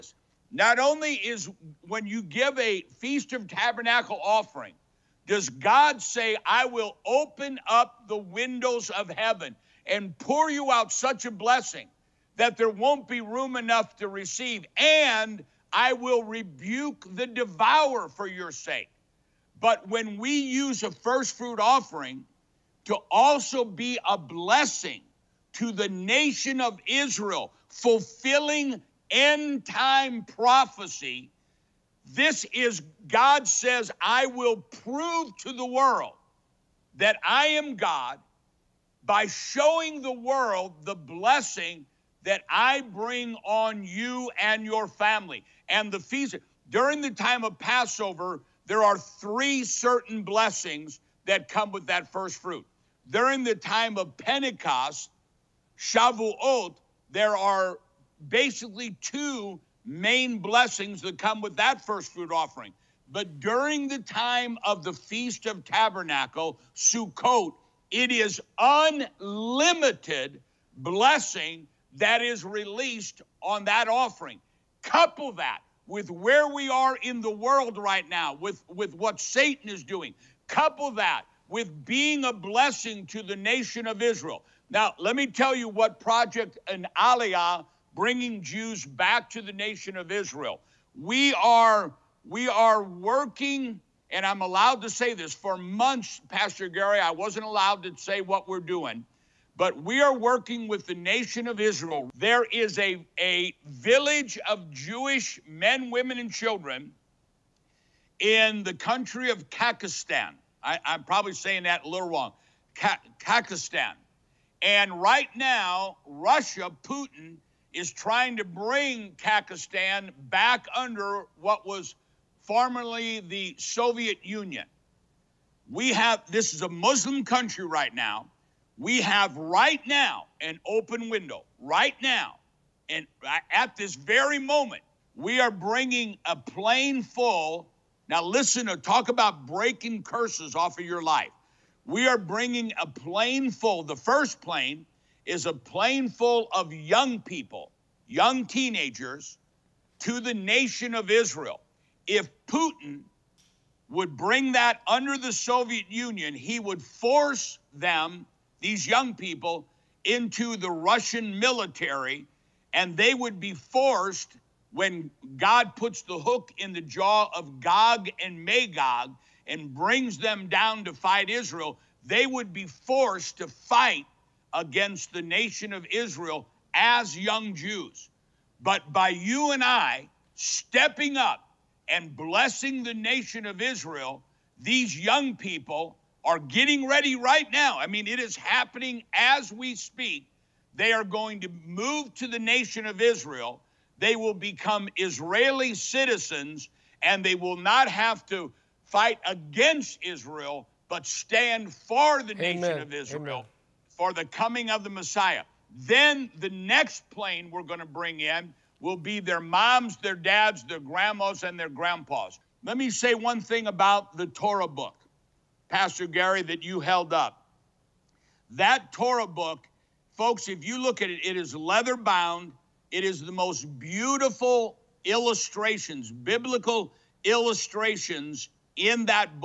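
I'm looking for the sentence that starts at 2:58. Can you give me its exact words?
But by you and I stepping up and blessing the nation of Israel, these young people are getting ready right now.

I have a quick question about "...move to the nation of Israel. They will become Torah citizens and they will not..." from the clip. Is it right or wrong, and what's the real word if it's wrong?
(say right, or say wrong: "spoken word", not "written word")
wrong: "Israeli", not "Torah".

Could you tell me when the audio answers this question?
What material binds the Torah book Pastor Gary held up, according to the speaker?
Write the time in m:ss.
3:41.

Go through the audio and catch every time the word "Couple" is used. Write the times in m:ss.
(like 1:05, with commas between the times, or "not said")
1:14, 1:20.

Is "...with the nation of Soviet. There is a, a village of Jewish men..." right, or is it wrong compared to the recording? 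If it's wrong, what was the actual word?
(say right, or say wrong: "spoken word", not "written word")
wrong: "Israel", not "Soviet".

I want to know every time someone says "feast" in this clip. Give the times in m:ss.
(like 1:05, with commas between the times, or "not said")
0:02, 0:45, 1:04.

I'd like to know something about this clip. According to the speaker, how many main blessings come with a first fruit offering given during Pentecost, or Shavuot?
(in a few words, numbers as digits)
2.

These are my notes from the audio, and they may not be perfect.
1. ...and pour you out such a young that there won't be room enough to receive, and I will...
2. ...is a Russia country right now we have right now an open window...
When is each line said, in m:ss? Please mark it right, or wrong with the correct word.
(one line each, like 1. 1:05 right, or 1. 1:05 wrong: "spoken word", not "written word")
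1. 0:09 wrong: "blessing", not "young"
2. 2:06 wrong: "Muslim", not "Russia".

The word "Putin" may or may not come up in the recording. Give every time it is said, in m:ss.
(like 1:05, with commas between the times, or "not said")
1:56, 2:32.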